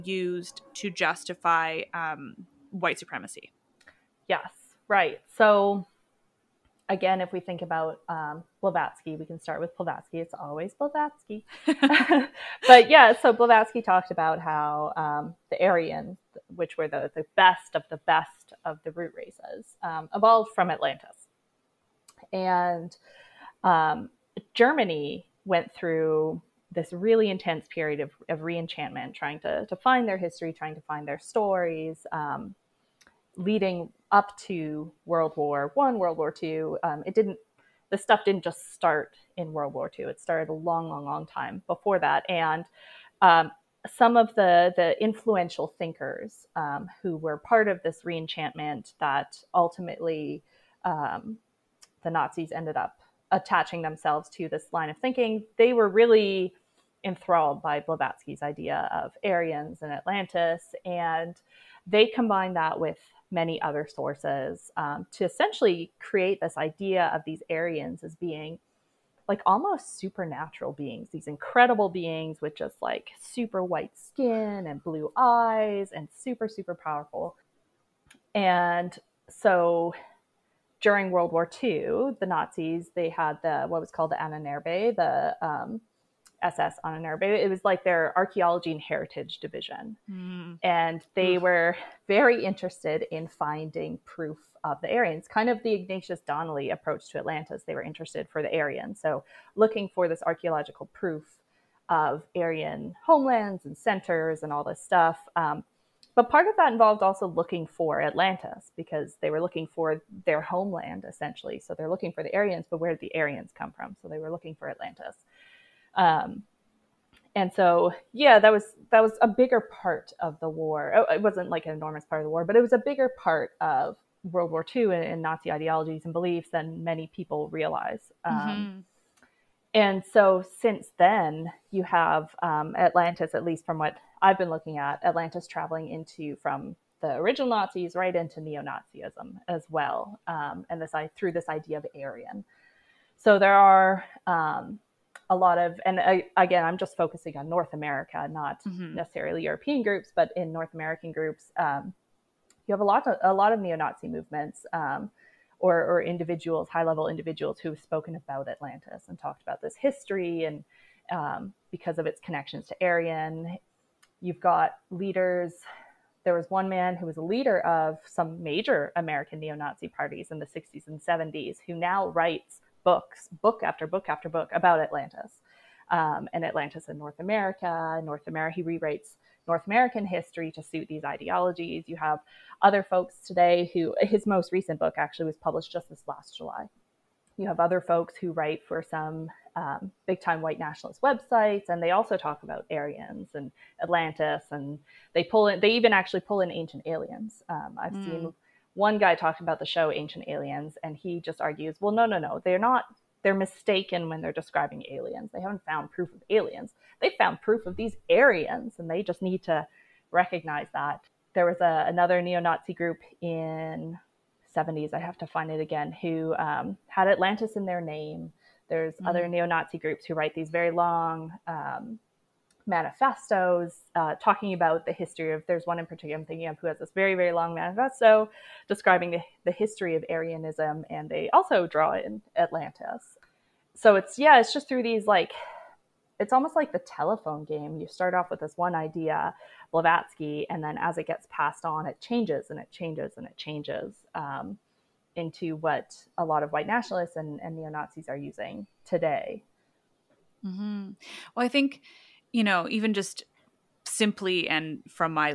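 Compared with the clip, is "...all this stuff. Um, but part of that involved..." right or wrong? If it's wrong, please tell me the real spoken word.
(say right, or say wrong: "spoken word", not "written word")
right.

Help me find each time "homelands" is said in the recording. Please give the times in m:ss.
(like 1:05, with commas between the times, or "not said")
1:43, 1:50.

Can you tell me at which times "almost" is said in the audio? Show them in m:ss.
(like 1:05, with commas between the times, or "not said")
1:09, 3:56.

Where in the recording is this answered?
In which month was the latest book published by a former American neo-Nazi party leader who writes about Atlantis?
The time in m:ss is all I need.
3:06.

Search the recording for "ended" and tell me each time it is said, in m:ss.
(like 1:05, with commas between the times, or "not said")
0:52.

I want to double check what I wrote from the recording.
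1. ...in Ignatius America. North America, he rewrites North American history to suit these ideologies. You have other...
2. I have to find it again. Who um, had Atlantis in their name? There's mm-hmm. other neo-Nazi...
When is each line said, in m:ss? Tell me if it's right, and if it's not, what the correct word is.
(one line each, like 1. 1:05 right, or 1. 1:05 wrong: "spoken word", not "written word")
1. 2:56 wrong: "North", not "Ignatius"
2. 3:34 right.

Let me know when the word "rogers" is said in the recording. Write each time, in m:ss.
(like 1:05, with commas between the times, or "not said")
not said.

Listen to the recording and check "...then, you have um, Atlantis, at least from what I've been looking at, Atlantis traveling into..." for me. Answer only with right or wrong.
right.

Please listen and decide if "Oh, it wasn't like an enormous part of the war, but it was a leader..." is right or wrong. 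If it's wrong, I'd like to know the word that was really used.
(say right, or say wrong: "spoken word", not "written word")
wrong: "bigger", not "leader".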